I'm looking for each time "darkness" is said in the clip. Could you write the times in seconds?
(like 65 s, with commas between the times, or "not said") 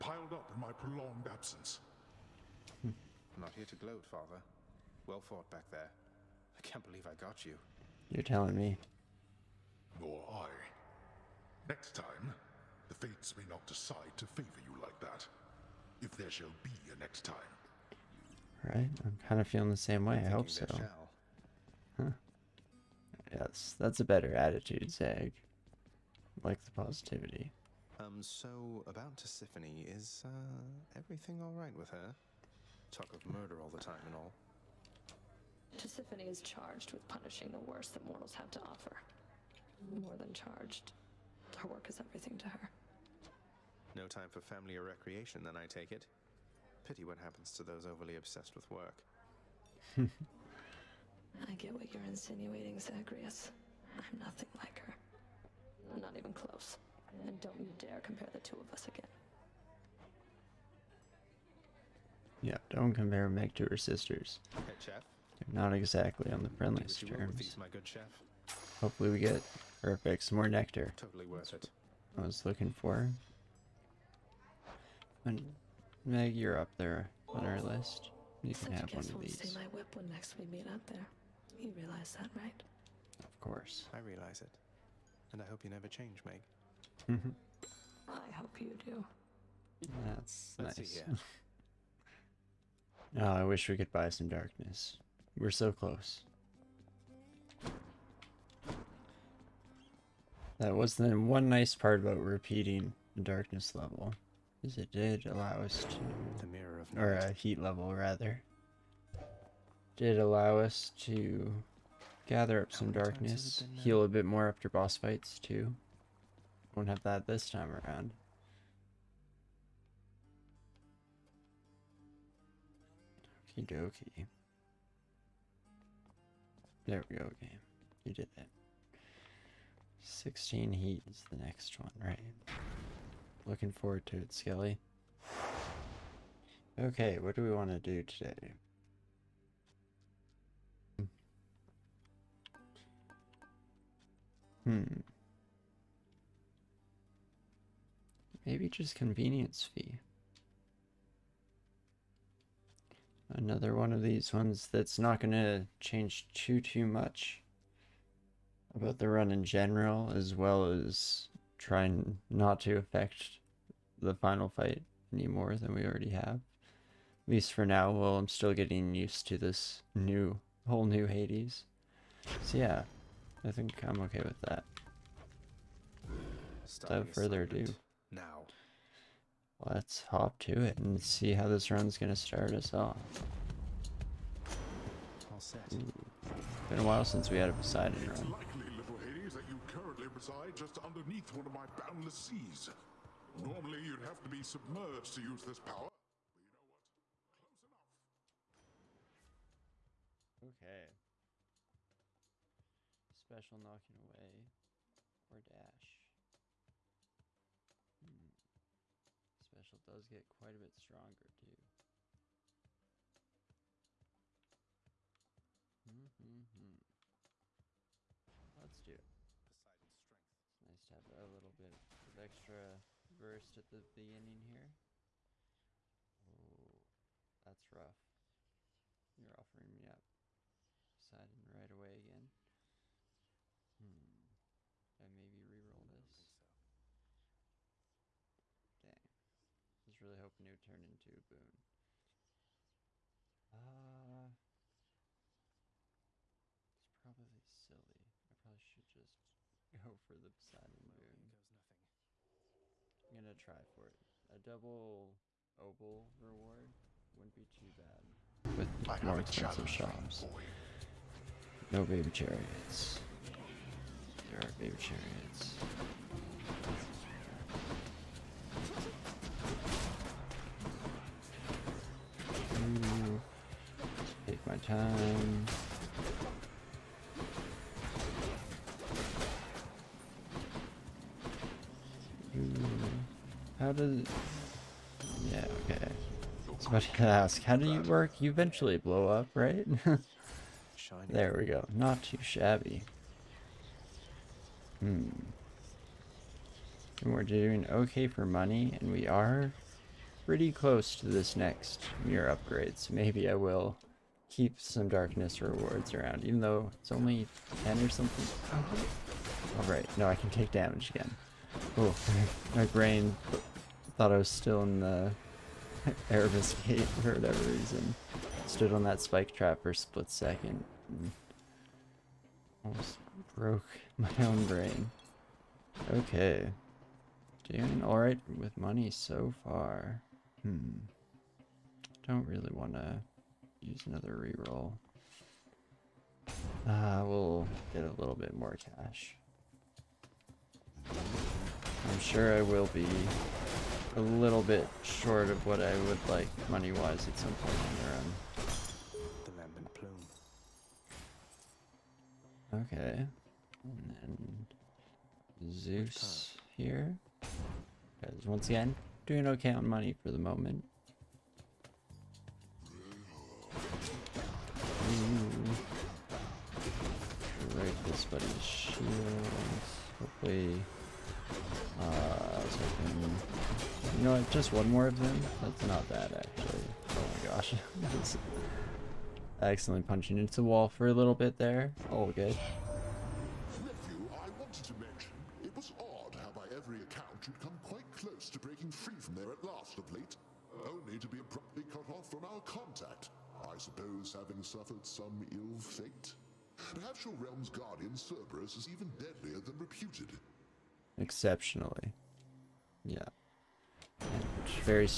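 94 s, 103 s, 112 s, 304 s.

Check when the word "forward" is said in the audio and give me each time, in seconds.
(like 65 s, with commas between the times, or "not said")
133 s.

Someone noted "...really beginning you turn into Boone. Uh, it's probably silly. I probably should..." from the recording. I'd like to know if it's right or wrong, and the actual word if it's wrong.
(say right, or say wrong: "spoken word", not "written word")
wrong: "hoping", not "beginning".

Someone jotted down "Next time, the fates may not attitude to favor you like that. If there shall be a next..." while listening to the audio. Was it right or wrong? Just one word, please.
wrong.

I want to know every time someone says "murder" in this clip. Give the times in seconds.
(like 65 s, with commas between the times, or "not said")
33 s.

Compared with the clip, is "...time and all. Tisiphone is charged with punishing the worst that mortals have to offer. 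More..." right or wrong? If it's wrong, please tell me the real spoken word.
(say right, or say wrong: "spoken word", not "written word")
right.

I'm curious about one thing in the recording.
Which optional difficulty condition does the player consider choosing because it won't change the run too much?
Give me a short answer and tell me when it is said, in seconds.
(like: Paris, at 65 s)
Convenience fee, at 148 s.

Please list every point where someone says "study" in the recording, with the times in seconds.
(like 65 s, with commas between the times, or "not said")
not said.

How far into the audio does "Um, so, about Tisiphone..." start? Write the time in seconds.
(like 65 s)
27 s.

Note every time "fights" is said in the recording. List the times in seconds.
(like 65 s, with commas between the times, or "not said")
114 s, 164 s.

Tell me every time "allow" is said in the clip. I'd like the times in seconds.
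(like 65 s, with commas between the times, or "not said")
105 s, 110 s.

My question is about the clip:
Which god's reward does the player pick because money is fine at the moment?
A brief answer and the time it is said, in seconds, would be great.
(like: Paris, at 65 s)
Zeus, at 355 s.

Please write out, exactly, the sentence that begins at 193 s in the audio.
Normally, you'd have to be submerged to use this power, but you know what?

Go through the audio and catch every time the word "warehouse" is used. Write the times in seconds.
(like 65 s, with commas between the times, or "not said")
not said.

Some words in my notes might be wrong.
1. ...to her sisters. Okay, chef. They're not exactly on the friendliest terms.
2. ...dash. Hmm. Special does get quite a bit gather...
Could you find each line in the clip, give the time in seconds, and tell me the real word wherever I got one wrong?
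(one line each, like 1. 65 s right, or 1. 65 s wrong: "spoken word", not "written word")
1. 63 s right
2. 205 s wrong: "stronger", not "gather".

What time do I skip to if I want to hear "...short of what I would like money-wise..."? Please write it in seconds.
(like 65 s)
344 s.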